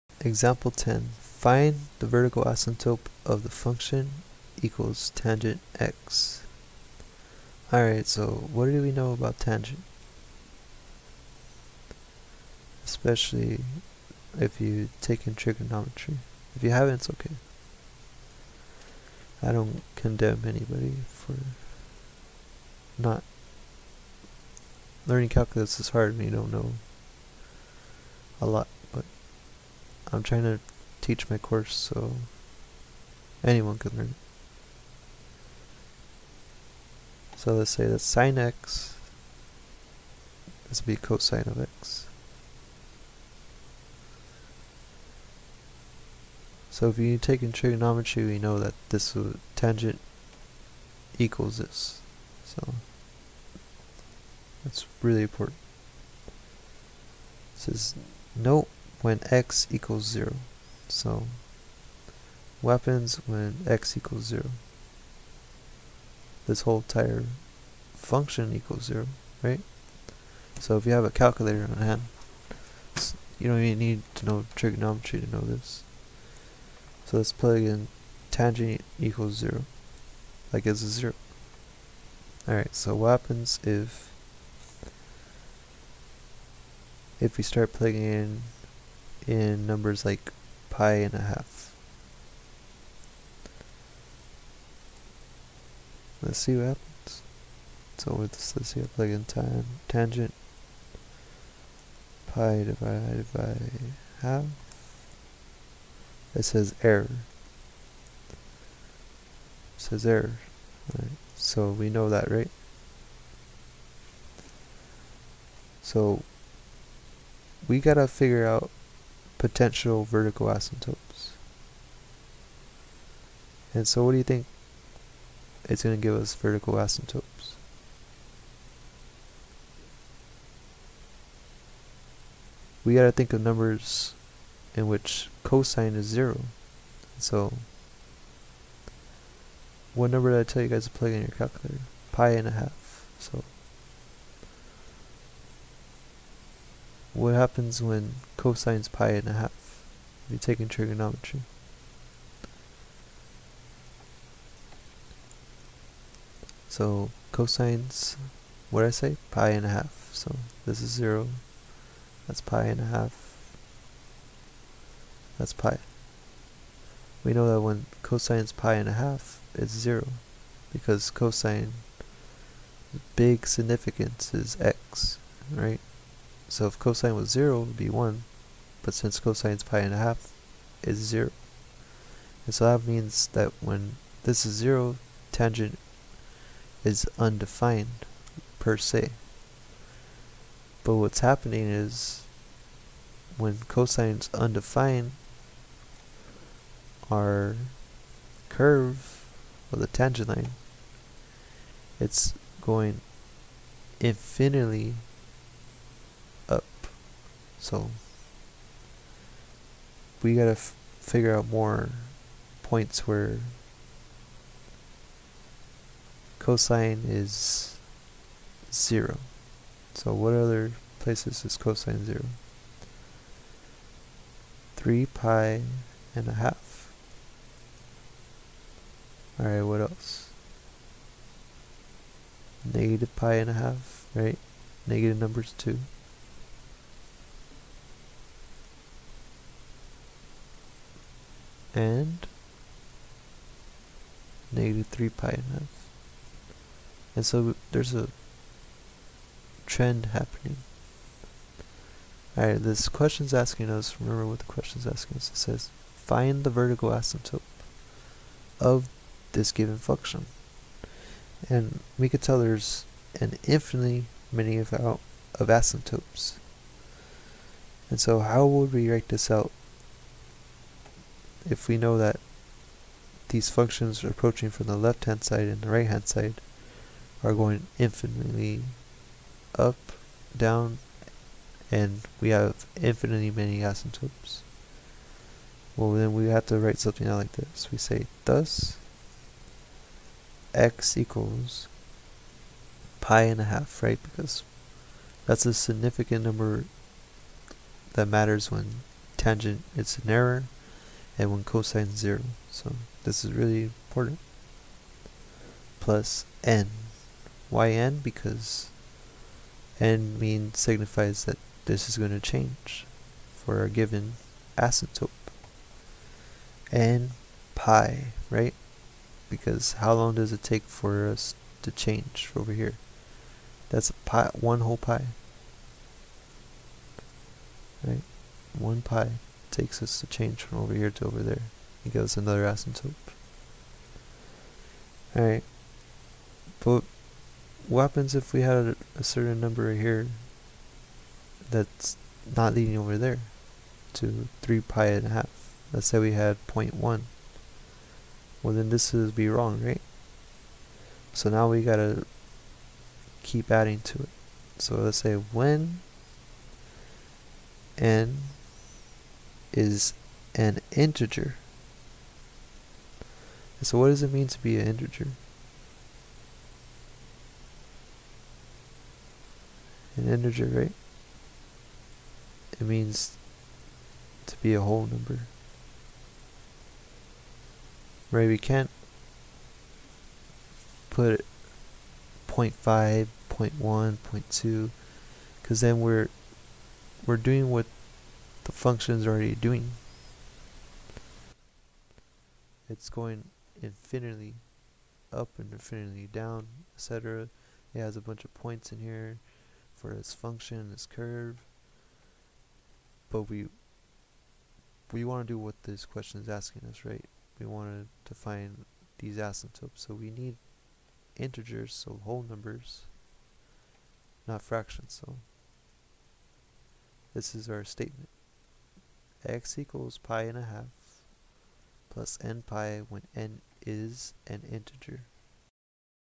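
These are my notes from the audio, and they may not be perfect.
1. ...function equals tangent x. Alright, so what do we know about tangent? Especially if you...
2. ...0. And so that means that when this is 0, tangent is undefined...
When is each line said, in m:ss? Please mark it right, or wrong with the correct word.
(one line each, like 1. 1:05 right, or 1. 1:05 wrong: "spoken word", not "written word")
1. 0:03 right
2. 3:00 right.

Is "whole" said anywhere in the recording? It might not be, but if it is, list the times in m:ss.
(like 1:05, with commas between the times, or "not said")
1:06, 5:24, 6:14, 6:52.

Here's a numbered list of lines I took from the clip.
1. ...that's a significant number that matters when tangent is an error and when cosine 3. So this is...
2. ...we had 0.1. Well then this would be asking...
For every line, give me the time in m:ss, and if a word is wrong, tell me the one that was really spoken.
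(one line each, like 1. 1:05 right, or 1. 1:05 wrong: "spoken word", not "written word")
1. 4:55 wrong: "0", not "3"
2. 5:45 wrong: "wrong", not "asking".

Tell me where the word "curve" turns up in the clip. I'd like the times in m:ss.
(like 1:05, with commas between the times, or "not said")
3:18, 6:40.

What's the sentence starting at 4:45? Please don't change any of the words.
Well then we have to write something out like this.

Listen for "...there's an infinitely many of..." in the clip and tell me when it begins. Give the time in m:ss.
4:22.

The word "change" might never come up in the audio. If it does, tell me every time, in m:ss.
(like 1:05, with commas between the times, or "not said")
5:12, 5:21, 5:30.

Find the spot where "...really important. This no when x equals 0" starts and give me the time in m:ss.
0:55.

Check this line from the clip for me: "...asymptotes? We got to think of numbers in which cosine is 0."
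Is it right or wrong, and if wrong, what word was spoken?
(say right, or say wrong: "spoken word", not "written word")
right.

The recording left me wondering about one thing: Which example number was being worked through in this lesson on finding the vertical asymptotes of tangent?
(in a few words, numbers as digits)
10.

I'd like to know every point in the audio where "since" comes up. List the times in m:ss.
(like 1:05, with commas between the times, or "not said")
2:58.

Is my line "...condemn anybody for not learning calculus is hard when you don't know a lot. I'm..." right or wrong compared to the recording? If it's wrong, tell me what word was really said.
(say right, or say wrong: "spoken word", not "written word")
right.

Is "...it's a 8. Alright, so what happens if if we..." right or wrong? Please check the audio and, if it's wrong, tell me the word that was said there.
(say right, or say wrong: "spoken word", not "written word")
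wrong: "0", not "8".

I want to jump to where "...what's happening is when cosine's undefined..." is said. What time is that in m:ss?
3:10.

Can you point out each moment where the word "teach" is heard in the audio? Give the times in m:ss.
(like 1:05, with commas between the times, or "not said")
0:30.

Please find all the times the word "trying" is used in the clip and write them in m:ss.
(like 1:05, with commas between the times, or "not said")
0:30.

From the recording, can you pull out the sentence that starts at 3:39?
So what other places is cosine zero?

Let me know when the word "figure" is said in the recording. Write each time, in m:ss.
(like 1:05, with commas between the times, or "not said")
1:58, 3:30.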